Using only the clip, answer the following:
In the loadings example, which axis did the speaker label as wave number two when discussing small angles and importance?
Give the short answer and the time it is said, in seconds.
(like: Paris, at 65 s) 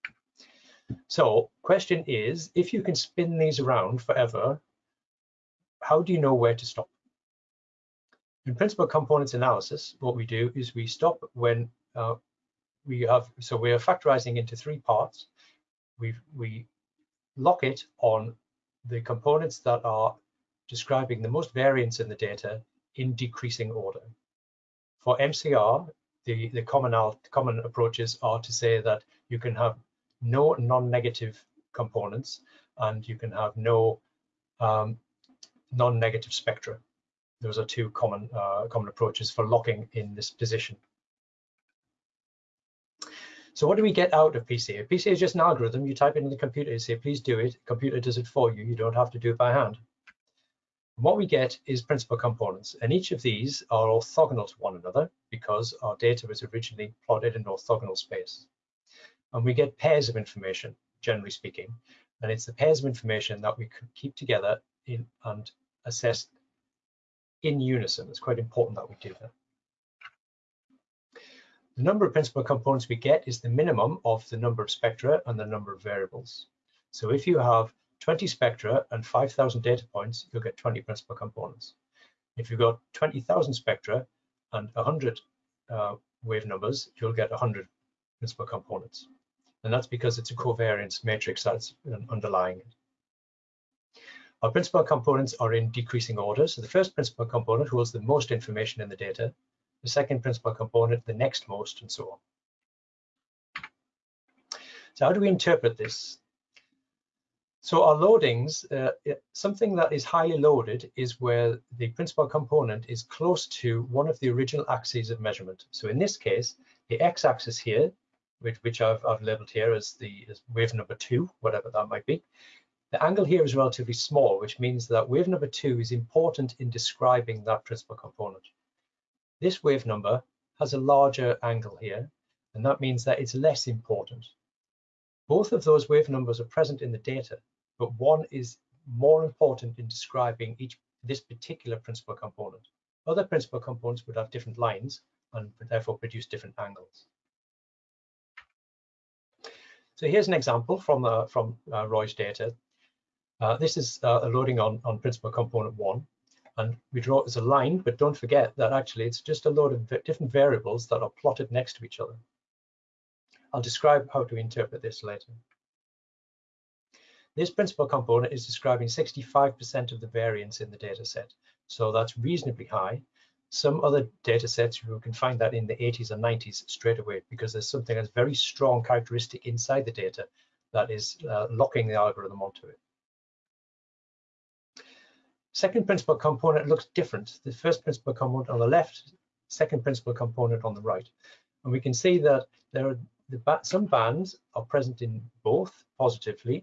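x-axis, at 117 s.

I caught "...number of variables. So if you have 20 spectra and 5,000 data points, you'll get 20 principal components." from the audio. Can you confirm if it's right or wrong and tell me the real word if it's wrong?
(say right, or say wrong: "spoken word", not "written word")
right.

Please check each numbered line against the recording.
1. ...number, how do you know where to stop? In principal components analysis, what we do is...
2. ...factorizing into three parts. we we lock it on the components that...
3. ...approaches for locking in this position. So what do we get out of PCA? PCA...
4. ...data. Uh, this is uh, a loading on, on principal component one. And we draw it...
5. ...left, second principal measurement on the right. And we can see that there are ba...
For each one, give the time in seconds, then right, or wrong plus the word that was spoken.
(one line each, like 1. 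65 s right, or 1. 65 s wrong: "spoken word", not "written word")
1. 4 s wrong: "forever", not "number"
2. 13 s right
3. 38 s right
4. 152 s right
5. 188 s wrong: "component", not "measurement".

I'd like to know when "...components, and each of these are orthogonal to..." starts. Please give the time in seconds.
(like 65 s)
52 s.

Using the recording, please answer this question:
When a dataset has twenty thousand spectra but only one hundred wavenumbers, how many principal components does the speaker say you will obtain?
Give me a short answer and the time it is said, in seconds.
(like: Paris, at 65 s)
100, at 87 s.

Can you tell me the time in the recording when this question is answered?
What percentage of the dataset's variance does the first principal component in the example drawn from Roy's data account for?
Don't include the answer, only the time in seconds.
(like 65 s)
168 s.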